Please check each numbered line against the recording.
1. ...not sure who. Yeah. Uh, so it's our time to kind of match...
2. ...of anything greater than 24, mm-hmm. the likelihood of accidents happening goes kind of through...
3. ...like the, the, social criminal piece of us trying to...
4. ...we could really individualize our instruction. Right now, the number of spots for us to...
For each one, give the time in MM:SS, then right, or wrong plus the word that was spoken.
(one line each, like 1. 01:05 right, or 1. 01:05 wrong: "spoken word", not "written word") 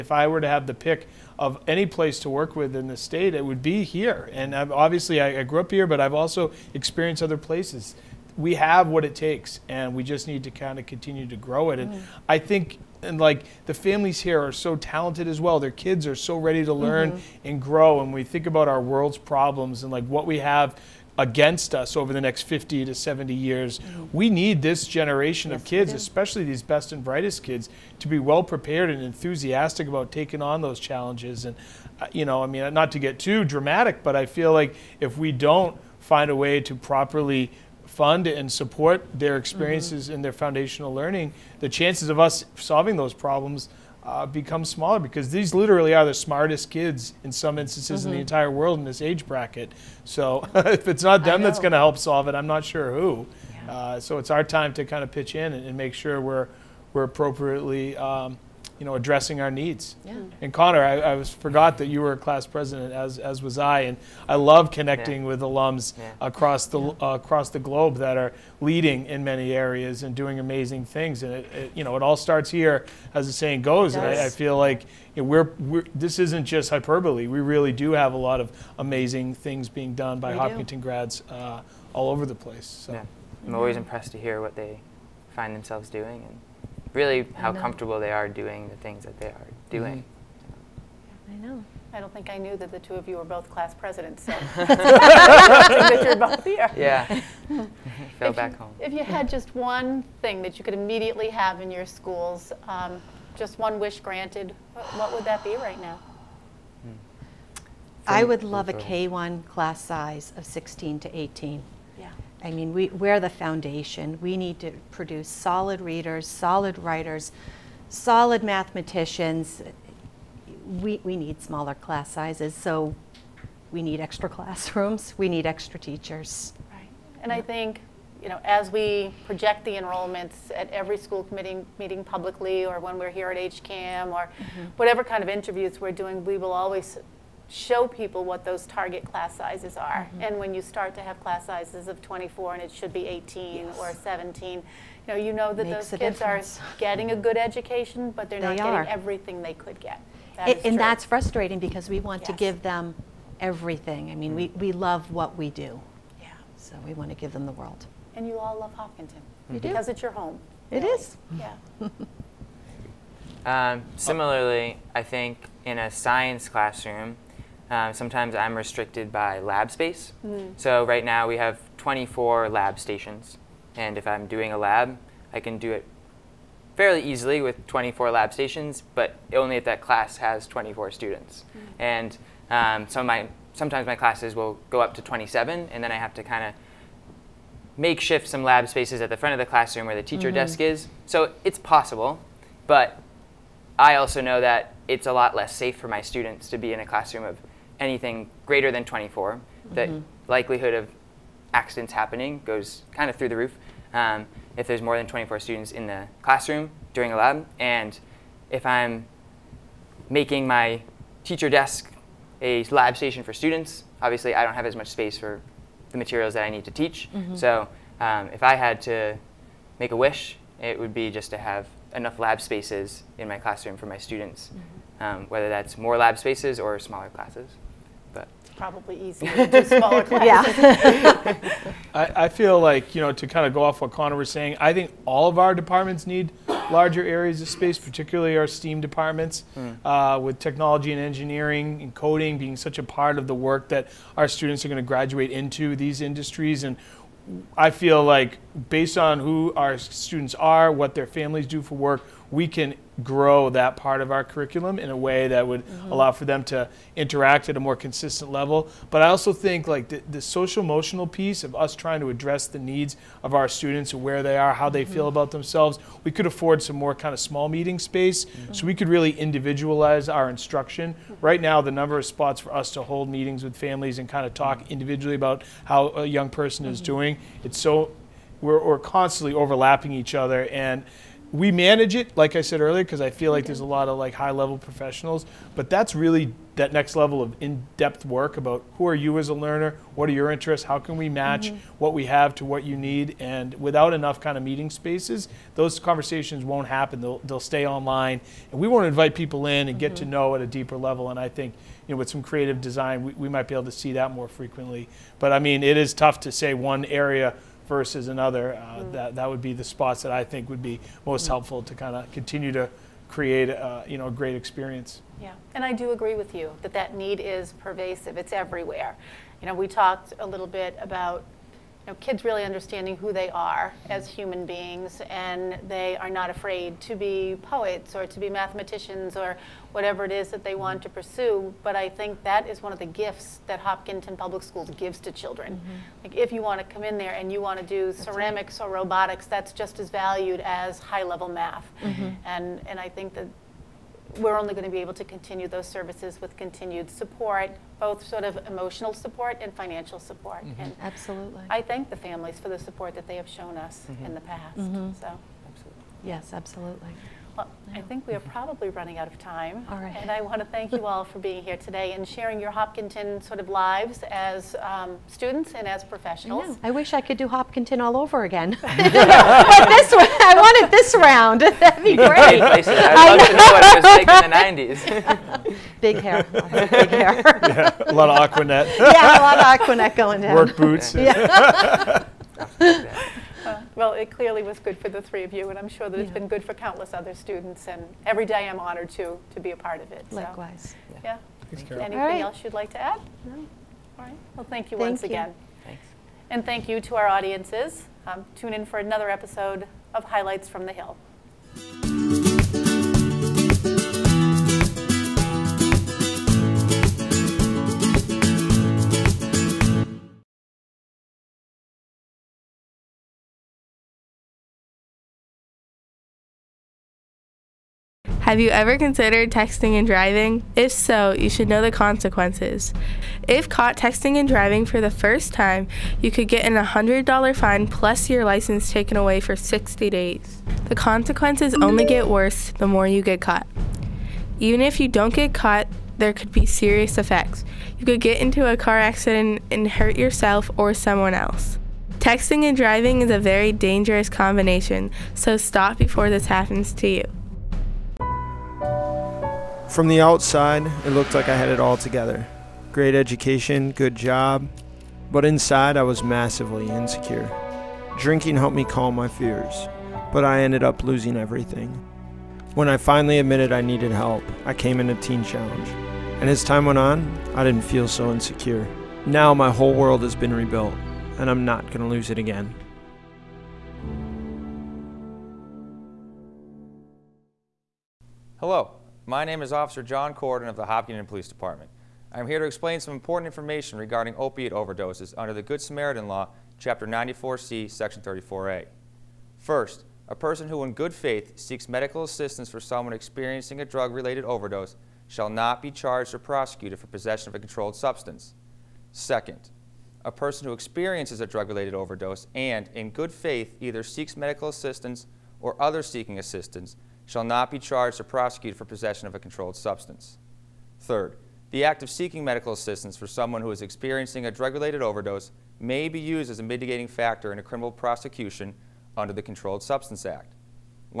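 1. 00:52 wrong: "pitch", not "match"
2. 03:17 right
3. 04:19 wrong: "emotional", not "criminal"
4. 04:28 right.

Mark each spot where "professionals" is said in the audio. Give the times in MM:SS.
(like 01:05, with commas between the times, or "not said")
04:44, 06:05.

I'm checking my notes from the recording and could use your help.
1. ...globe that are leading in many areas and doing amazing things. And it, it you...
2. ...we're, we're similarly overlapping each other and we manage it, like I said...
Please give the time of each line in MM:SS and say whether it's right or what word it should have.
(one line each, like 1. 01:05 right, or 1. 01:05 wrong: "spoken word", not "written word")
1. 01:07 right
2. 04:38 wrong: "constantly", not "similarly".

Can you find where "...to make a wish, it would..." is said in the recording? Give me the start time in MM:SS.
03:38.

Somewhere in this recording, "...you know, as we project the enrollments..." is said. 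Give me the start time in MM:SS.
02:08.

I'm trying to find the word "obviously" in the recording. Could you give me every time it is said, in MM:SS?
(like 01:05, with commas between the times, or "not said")
00:04, 03:34.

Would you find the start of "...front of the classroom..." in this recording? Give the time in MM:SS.
03:09.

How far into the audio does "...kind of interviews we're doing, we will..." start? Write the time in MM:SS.
02:15.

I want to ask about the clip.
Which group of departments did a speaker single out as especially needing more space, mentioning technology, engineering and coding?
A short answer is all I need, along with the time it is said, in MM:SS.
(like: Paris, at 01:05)
STEAM departments, at 03:58.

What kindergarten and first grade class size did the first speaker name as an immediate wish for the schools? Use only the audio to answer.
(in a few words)
16 to 18.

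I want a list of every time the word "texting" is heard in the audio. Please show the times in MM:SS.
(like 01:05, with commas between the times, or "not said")
06:59, 07:03, 07:21.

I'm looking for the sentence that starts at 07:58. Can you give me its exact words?
Hello, my name is Officer John Corden of the Hopkinton Police Department.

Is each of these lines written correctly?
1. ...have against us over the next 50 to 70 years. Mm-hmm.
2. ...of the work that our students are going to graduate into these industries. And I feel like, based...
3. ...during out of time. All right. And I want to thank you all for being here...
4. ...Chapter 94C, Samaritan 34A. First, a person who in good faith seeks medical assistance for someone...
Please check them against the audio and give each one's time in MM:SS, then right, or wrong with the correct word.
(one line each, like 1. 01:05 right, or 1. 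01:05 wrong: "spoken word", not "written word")
1. 00:20 right
2. 04:03 right
3. 05:58 wrong: "running", not "during"
4. 08:06 wrong: "Section", not "Samaritan".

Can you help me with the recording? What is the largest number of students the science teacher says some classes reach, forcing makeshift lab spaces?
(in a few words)
27.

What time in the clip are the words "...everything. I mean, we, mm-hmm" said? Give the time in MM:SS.
02:33.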